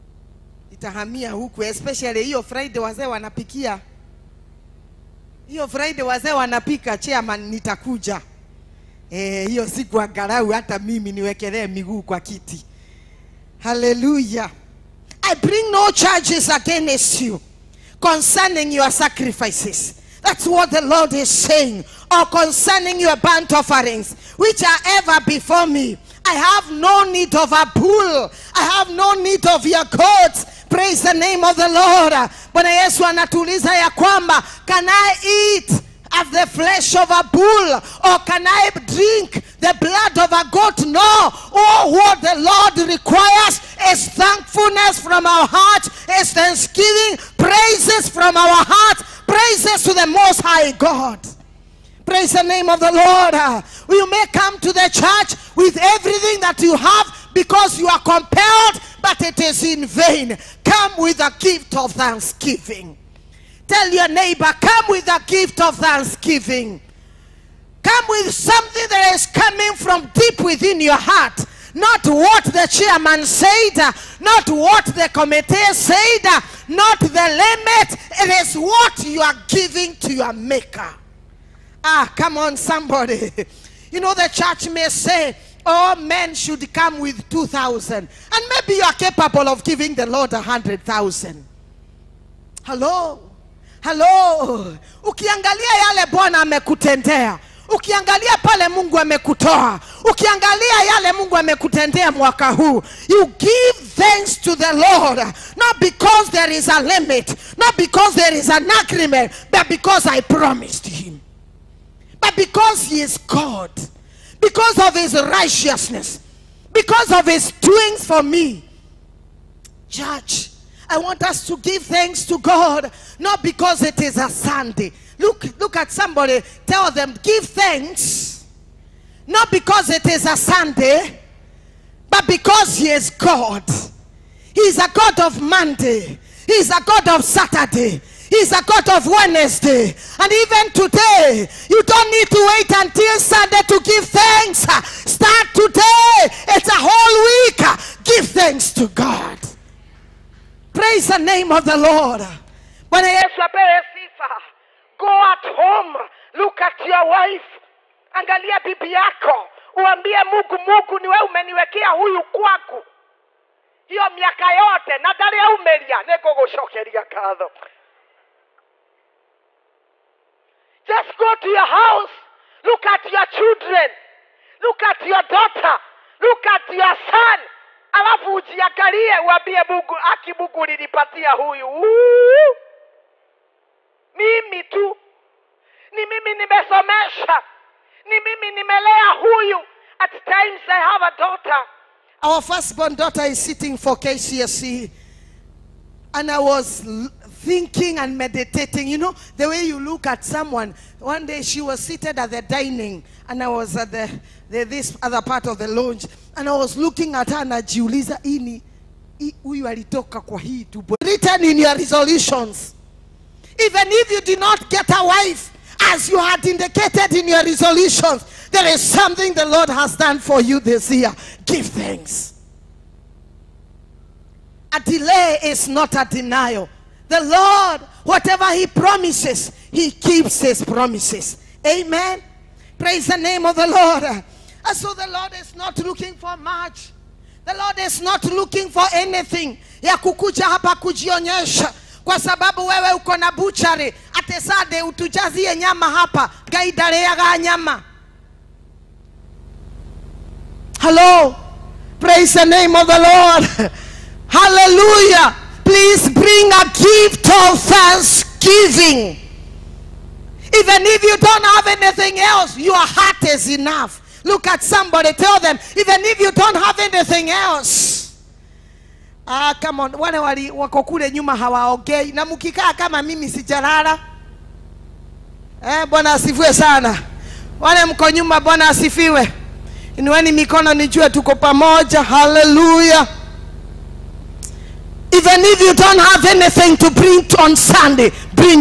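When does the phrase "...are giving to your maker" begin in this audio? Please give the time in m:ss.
1:19.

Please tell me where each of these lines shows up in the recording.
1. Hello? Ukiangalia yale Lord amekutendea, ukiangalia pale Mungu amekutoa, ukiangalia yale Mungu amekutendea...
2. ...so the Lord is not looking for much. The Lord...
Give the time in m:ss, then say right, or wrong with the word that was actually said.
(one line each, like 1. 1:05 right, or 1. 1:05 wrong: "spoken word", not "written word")
1. 1:33 wrong: "Bwana", not "Lord"
2. 3:54 right.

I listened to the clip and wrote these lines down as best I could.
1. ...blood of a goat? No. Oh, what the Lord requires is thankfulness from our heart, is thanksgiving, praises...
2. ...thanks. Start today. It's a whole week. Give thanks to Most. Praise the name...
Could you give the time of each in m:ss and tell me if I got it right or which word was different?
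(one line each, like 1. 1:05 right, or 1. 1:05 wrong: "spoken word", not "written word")
1. 0:39 right
2. 2:24 wrong: "God", not "Most".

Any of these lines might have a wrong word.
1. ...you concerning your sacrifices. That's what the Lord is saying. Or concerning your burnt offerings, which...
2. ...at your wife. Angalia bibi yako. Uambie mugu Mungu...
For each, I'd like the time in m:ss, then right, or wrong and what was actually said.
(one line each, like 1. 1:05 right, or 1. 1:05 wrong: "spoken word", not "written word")
1. 0:17 right
2. 2:36 right.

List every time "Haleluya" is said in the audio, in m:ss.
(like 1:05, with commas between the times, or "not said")
0:13, 4:42.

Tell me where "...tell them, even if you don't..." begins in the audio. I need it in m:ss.
4:25.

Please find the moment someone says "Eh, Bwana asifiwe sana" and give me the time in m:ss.
4:35.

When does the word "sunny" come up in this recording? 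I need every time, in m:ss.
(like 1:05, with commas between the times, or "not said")
not said.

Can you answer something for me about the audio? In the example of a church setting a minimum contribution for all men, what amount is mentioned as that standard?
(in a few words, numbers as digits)
2,000.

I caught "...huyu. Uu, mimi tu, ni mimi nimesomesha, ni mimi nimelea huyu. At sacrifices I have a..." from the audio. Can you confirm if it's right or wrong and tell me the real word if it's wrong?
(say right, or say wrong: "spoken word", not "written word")
wrong: "times", not "sacrifices".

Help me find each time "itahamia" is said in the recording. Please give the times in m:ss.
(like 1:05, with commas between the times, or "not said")
0:00.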